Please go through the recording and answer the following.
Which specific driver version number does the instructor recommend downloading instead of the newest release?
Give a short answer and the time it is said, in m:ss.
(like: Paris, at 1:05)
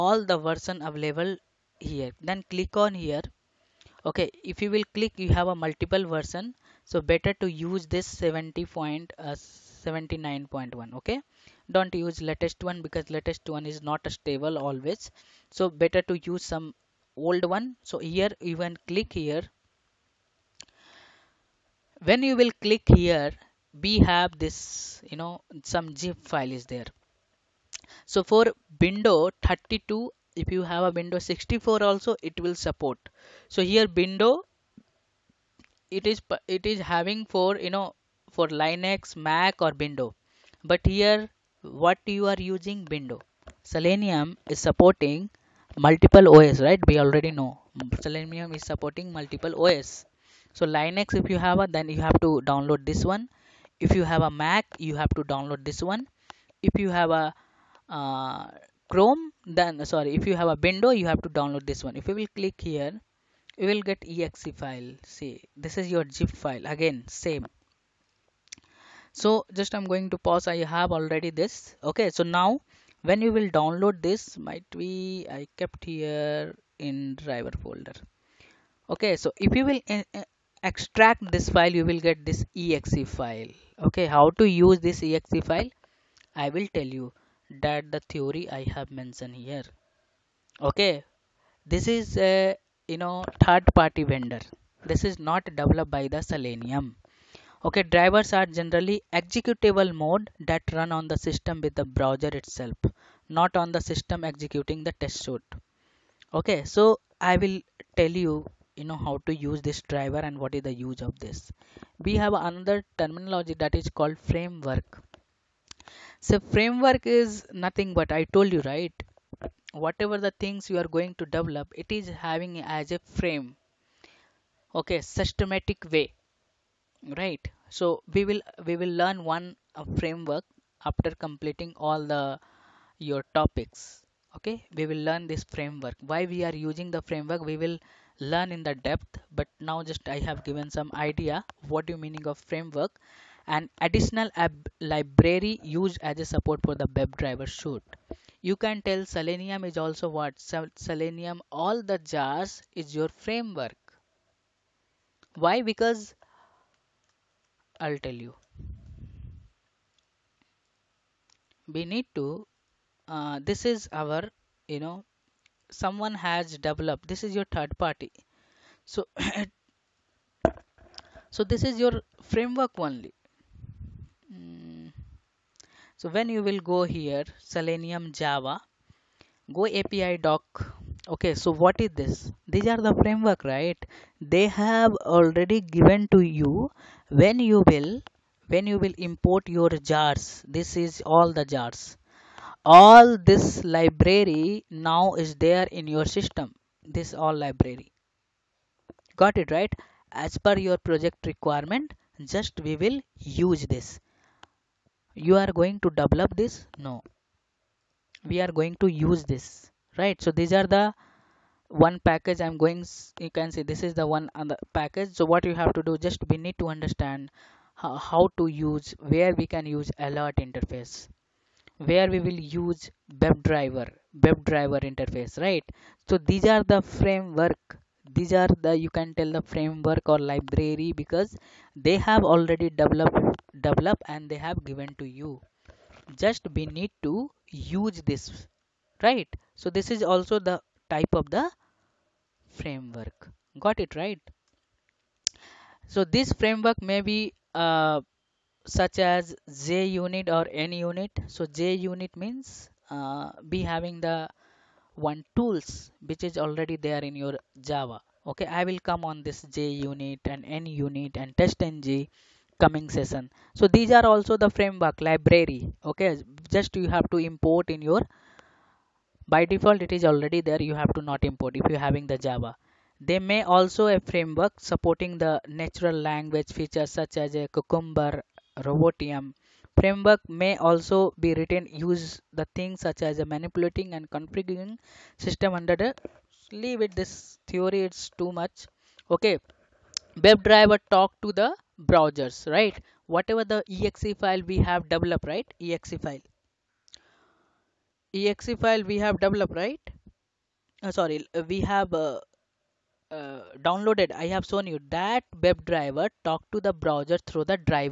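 70.79.1, at 0:08.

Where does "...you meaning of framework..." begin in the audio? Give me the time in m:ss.
2:21.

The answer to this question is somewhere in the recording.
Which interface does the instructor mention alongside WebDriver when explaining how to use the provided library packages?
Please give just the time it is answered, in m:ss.
3:39.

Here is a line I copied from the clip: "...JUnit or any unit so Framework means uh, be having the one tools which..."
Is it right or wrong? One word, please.
wrong.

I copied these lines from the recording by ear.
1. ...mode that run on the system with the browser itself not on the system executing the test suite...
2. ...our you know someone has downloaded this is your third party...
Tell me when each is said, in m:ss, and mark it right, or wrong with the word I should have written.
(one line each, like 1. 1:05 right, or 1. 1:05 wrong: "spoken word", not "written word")
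1. 1:40 right
2. 2:44 wrong: "developed", not "downloaded".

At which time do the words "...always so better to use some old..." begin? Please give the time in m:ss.
0:14.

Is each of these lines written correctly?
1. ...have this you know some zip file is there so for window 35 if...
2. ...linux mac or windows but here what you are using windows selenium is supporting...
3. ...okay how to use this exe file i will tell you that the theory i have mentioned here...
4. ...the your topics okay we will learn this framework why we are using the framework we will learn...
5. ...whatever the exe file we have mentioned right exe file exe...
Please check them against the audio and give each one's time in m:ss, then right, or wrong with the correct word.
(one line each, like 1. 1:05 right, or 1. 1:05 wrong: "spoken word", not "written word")
1. 0:23 wrong: "32", not "35"
2. 0:38 right
3. 1:23 right
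4. 2:12 right
5. 4:53 wrong: "developed", not "mentioned".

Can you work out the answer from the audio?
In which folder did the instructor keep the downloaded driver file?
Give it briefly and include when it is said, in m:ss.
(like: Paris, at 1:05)
driver folder, at 1:17.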